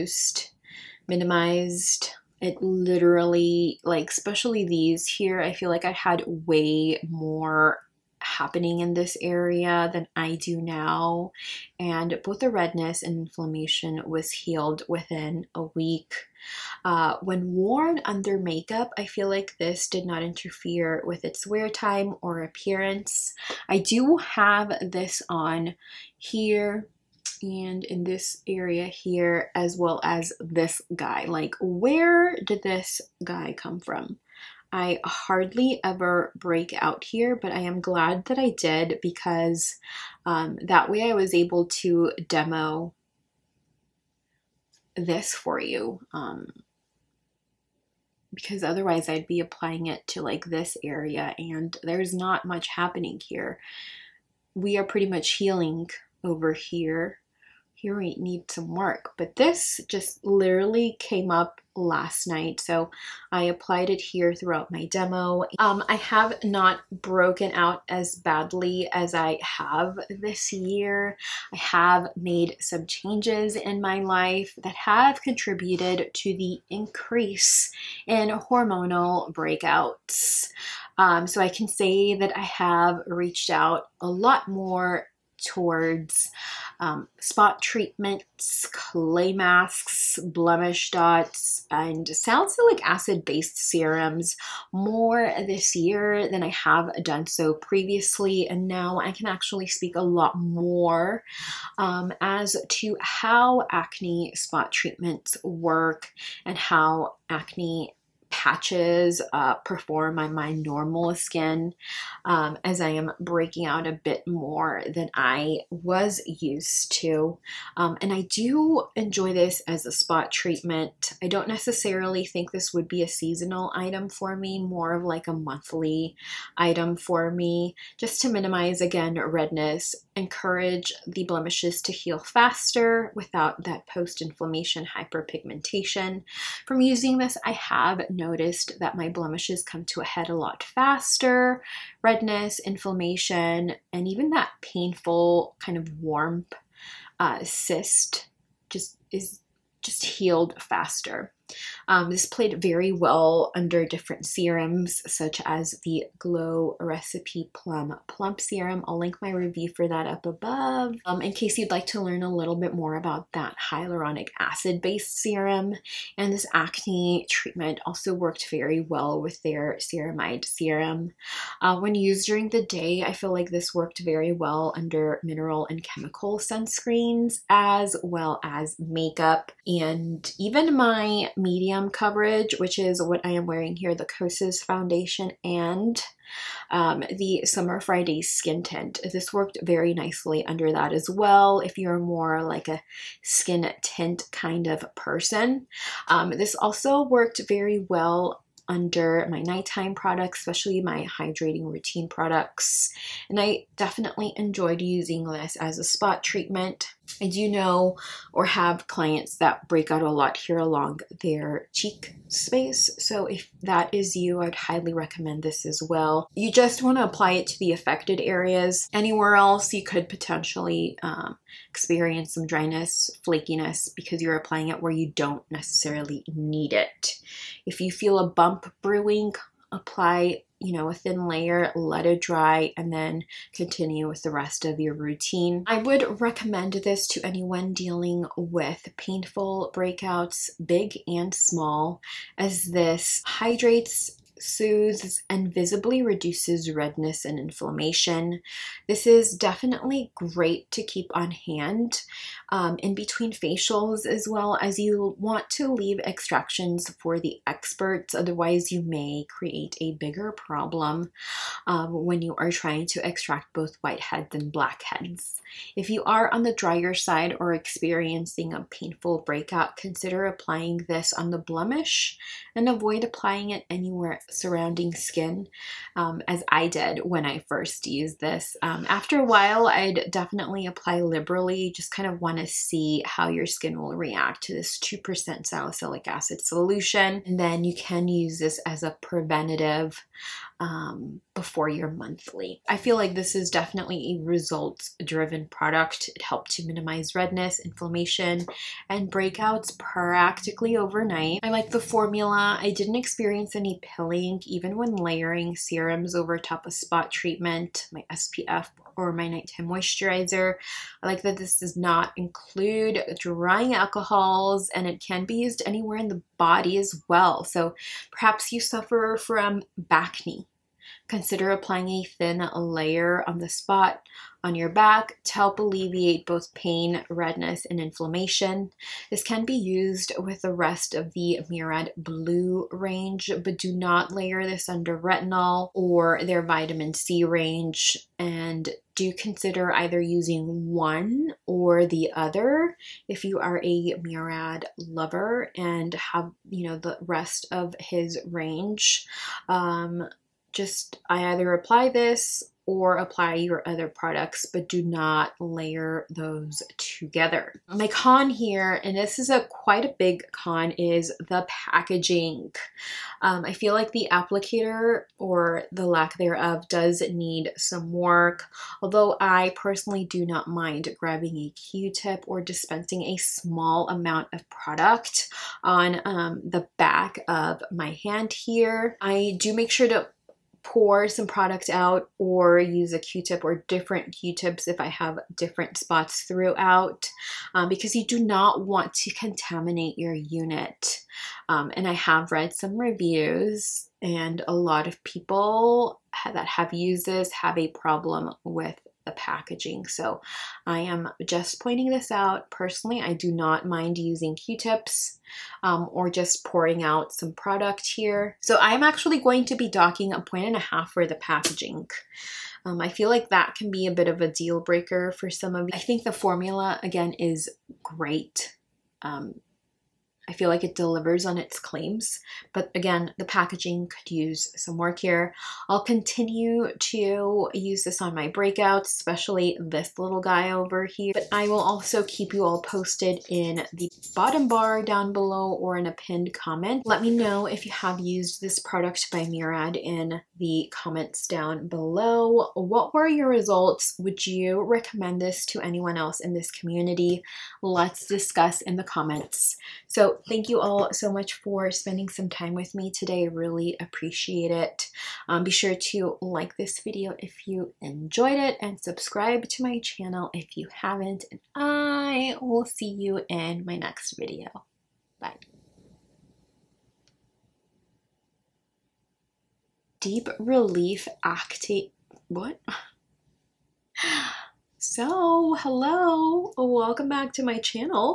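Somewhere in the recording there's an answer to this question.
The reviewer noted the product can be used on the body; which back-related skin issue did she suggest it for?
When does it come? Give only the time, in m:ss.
5:19.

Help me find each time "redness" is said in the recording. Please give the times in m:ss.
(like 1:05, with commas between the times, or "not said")
0:12, 2:09, 2:22, 4:06, 4:57, 5:27.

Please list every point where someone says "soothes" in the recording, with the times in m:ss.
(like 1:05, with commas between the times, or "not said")
4:04.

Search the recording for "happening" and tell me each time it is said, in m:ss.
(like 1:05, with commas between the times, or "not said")
0:08, 0:52.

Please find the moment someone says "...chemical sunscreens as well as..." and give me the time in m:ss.
2:55.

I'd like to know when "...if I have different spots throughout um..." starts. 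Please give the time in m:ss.
6:24.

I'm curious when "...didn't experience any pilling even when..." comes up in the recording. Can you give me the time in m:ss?
5:02.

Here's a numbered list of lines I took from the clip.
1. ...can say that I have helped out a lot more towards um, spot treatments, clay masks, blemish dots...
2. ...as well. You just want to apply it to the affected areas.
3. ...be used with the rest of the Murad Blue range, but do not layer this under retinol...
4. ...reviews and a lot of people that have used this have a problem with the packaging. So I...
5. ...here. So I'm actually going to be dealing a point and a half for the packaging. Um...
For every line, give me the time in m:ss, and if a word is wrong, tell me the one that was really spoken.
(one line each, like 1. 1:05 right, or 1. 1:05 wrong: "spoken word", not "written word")
1. 1:21 wrong: "reached", not "helped"
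2. 3:35 right
3. 5:29 right
4. 6:32 right
5. 6:47 wrong: "docking", not "dealing".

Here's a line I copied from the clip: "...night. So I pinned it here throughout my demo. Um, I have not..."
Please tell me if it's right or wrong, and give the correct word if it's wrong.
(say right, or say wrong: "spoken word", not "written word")
wrong: "applied", not "pinned".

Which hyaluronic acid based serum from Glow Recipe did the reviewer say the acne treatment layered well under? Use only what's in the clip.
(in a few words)
Plum Plump Serum.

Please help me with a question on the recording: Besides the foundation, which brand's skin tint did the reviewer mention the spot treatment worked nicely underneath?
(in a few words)
Summer Fridays.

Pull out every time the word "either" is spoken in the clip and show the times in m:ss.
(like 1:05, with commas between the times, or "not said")
5:39, 5:51.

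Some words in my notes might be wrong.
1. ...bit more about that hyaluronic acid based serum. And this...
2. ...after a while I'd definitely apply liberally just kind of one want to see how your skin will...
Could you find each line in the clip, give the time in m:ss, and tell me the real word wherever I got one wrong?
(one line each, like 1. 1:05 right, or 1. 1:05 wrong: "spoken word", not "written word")
1. 2:42 right
2. 4:38 right.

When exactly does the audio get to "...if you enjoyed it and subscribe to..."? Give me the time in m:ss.
7:37.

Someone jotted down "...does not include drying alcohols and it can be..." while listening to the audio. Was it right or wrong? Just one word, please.
right.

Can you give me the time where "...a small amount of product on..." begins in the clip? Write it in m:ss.
6:13.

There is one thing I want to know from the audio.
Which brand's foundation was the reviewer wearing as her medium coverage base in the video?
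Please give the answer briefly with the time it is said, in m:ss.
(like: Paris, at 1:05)
Kosas, at 3:04.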